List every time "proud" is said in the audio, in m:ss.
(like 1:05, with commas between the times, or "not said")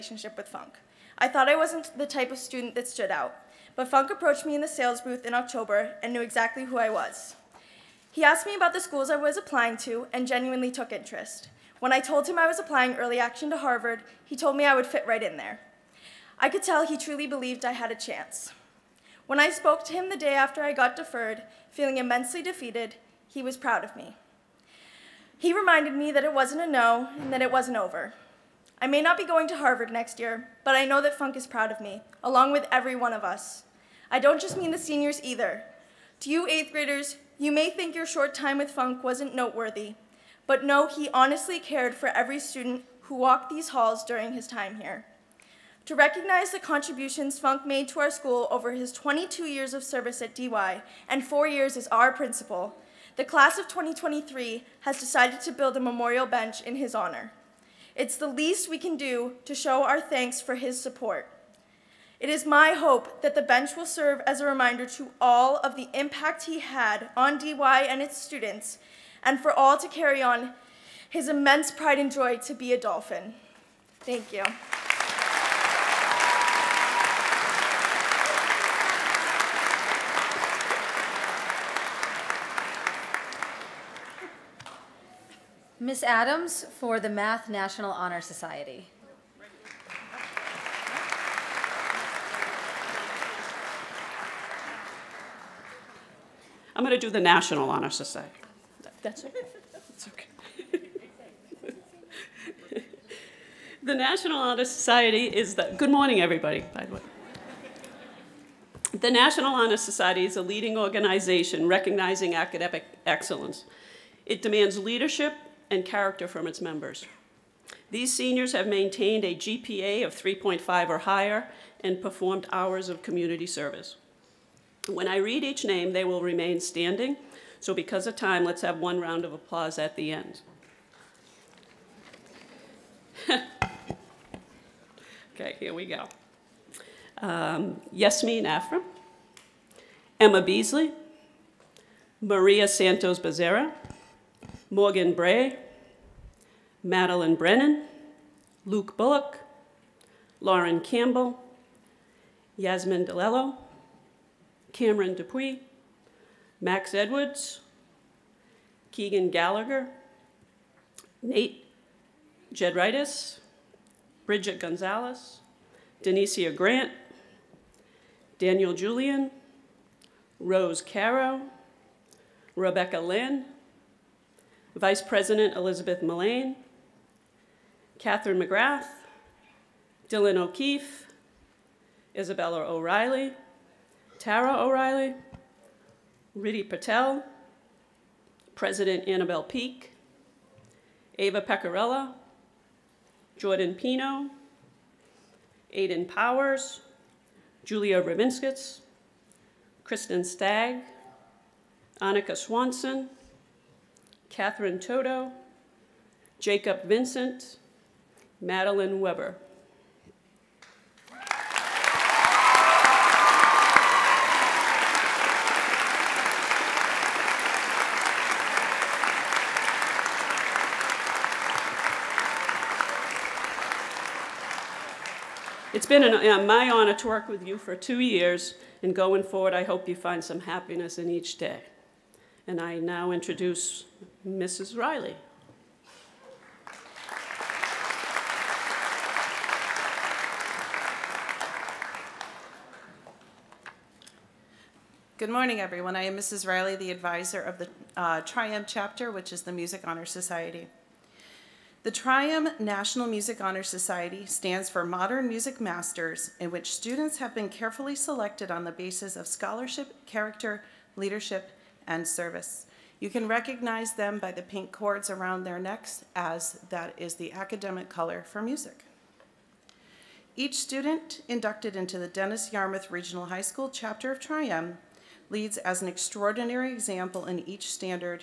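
0:23, 0:31.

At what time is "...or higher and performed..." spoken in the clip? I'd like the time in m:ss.
2:00.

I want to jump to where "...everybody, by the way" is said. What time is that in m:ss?
1:46.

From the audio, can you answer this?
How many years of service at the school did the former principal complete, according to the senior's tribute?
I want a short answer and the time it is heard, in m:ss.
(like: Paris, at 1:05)
22, at 0:48.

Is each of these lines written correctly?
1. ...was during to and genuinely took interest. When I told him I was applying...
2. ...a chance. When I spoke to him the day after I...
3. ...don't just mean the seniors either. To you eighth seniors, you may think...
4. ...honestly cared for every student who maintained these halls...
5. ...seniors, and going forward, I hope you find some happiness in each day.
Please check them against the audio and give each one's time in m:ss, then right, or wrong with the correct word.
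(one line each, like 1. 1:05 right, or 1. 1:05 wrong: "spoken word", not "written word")
1. 0:09 wrong: "applying", not "during"
2. 0:17 right
3. 0:34 wrong: "graders", not "seniors"
4. 0:41 wrong: "walked", not "maintained"
5. 3:47 wrong: "years", not "seniors".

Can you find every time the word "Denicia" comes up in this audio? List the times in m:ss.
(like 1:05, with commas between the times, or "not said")
2:46.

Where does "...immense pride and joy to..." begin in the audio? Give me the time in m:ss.
1:11.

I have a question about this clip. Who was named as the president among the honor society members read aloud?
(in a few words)
Annabelle Peak.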